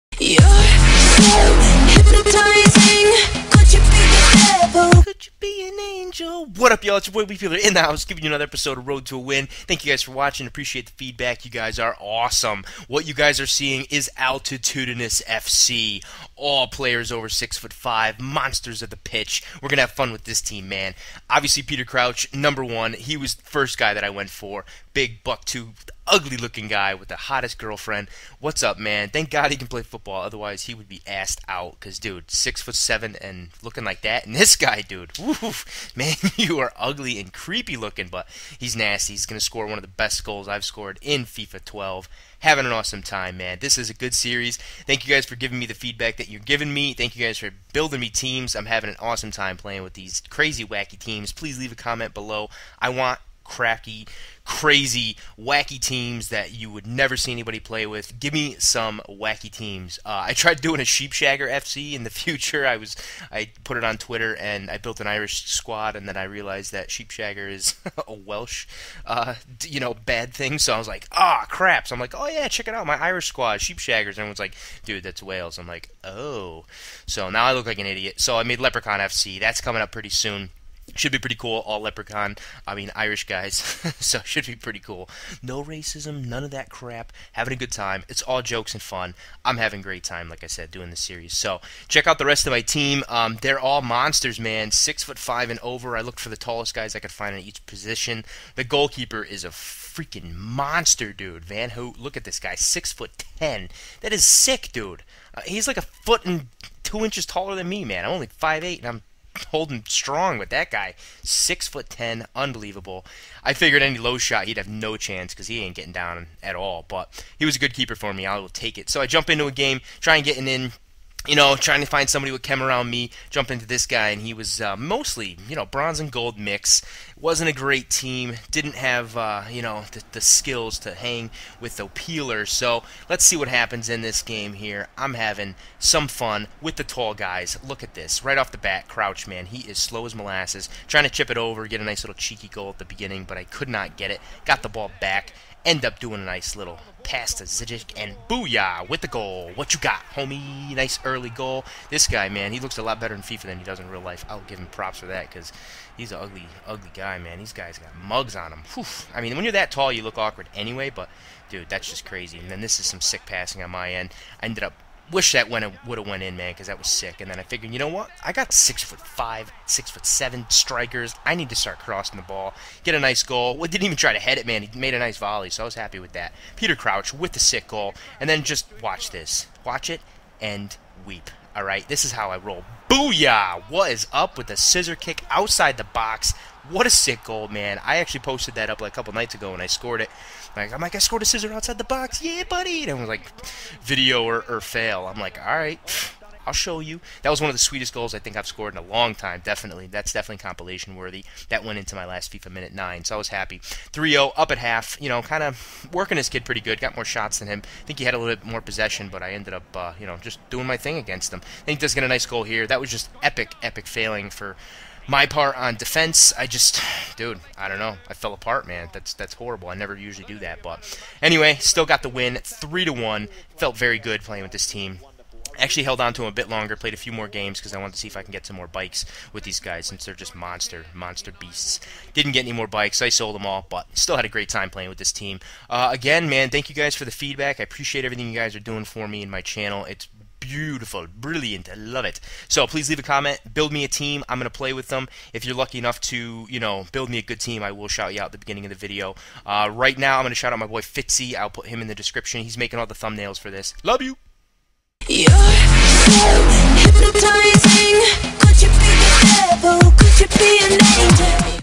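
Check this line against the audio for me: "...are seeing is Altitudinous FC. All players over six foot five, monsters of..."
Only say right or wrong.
right.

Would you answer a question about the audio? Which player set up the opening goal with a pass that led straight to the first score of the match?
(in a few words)
Zigic.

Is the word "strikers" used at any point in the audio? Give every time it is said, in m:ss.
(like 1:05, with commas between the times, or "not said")
2:50.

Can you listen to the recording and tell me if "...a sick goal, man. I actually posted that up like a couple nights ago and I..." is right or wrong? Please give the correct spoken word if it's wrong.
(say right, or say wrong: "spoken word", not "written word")
right.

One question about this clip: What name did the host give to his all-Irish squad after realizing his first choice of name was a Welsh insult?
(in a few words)
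Leprechaun FC.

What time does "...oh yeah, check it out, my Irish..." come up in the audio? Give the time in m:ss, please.
1:12.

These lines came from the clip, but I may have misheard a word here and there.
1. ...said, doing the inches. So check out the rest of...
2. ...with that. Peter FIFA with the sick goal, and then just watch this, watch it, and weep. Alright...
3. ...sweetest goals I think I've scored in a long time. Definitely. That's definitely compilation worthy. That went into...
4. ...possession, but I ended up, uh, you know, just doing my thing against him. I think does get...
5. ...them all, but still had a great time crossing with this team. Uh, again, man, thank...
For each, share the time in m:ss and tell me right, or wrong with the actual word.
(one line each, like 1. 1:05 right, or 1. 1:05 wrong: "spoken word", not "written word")
1. 1:30 wrong: "series", not "inches"
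2. 2:55 wrong: "Crouch", not "FIFA"
3. 3:17 right
4. 3:28 right
5. 3:53 wrong: "playing", not "crossing".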